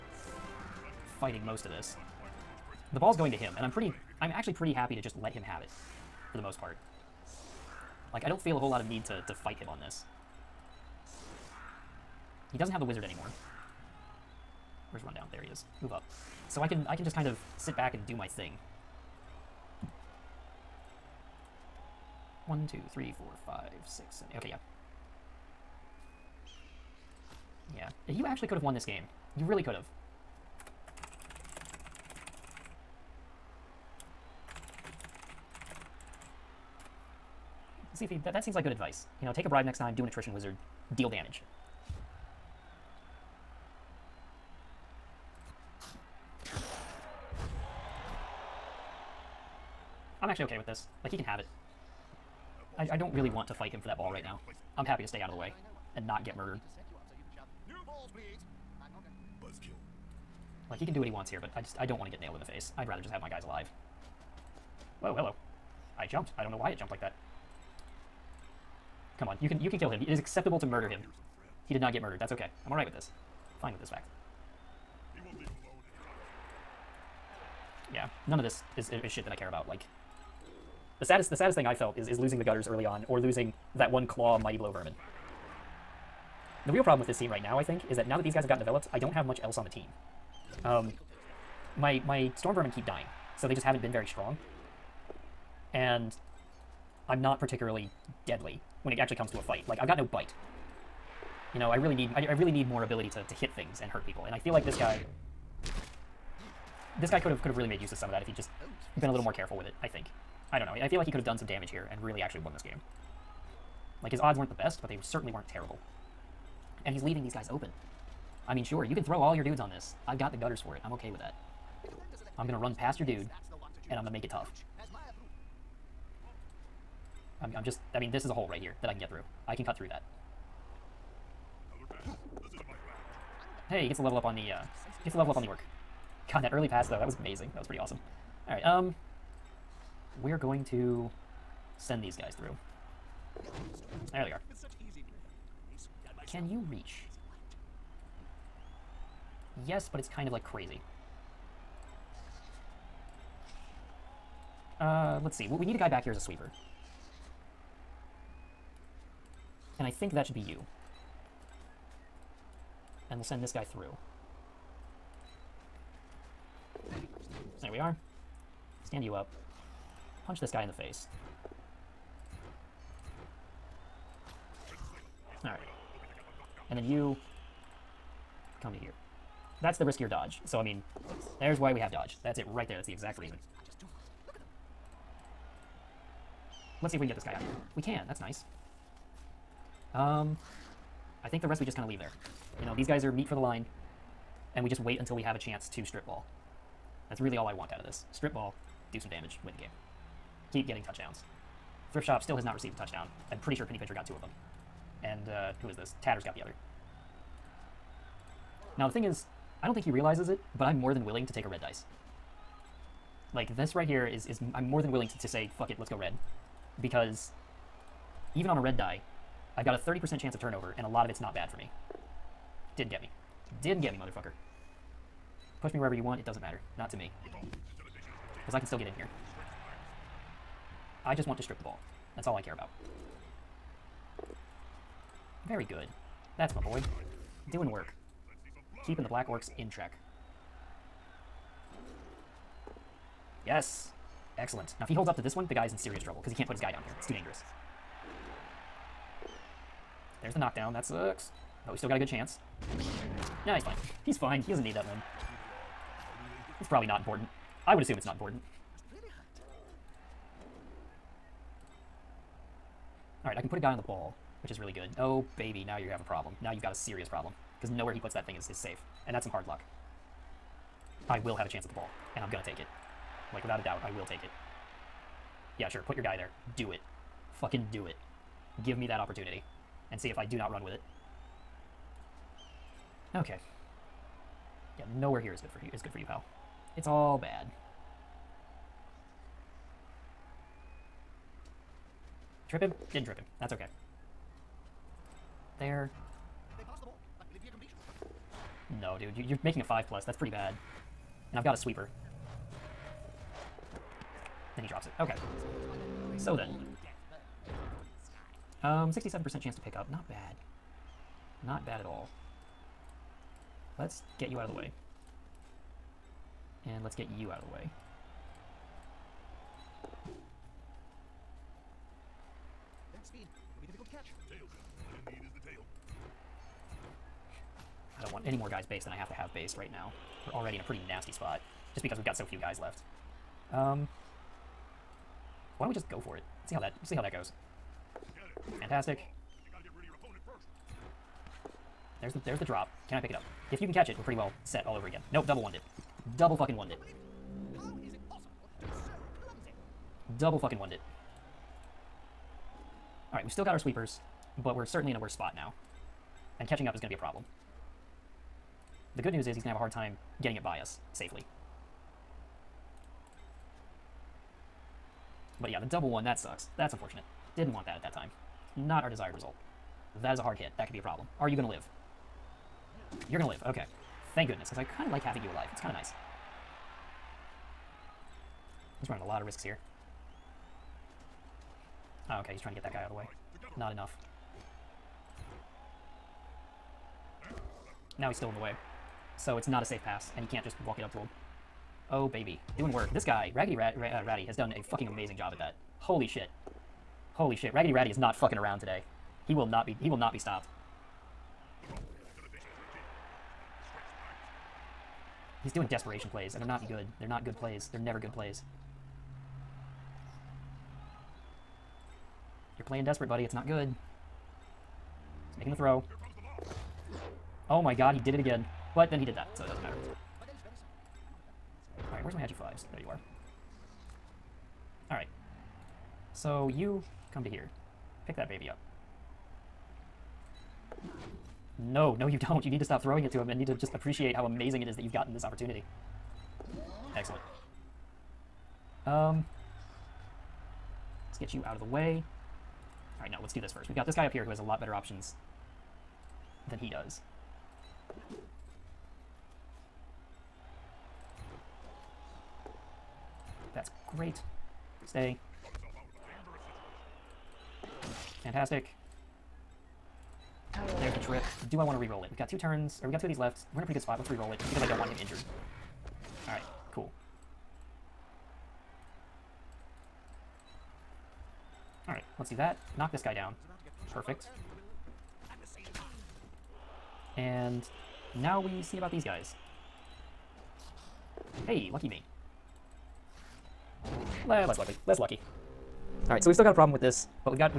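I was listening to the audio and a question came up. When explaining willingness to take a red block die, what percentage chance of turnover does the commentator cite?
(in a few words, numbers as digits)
30%.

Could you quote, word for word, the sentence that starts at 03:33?
Like, this right here is, is I'm more than willing to, to say, fuck it, let's go red.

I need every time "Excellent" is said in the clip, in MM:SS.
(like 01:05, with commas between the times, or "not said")
04:04, 07:16.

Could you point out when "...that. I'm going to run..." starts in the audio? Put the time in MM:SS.
02:01.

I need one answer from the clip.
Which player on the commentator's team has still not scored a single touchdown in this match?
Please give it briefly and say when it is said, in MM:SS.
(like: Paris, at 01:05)
Thrift Shop, at 03:21.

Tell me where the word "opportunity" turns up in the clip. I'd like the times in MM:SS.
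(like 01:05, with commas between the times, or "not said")
04:38, 07:15.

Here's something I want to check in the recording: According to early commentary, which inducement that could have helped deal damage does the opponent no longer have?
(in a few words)
the wizard.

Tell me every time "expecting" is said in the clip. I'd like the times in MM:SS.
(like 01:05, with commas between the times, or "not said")
not said.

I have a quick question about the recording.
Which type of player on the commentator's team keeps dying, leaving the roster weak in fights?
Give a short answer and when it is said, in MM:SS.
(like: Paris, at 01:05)
storm vermin, at 01:32.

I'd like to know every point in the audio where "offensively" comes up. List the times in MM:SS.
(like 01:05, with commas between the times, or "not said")
not said.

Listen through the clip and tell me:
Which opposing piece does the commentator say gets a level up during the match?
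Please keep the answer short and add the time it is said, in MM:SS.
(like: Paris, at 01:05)
the orc, at 02:15.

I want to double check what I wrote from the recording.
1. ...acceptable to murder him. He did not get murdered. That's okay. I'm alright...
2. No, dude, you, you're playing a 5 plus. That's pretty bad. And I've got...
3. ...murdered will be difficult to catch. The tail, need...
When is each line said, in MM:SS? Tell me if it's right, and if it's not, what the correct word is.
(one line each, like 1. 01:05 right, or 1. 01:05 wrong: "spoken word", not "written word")
1. 01:10 right
2. 04:58 wrong: "making", not "playing"
3. 05:23 wrong: "speed", not "murdered".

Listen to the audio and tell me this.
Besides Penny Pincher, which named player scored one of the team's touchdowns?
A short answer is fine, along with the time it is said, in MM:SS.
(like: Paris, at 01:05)
Tatters, at 03:26.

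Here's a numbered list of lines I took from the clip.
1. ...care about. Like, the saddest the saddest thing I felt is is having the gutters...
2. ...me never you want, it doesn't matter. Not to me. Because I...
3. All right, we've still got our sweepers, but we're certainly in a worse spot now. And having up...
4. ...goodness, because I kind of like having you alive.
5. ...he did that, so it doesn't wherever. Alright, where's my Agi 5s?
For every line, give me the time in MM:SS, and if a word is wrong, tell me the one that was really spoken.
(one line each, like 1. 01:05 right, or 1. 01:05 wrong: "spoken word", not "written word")
1. 01:19 wrong: "losing", not "having"
2. 03:45 wrong: "wherever", not "never"
3. 05:53 wrong: "catching", not "having"
4. 06:14 right
5. 06:58 wrong: "matter", not "wherever".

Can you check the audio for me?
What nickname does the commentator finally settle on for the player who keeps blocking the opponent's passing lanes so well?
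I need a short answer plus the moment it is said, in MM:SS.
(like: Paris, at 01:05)
Raggedy Ratty, at 06:37.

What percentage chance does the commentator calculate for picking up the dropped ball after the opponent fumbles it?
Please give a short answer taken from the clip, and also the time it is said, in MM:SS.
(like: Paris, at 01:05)
67%, at 05:08.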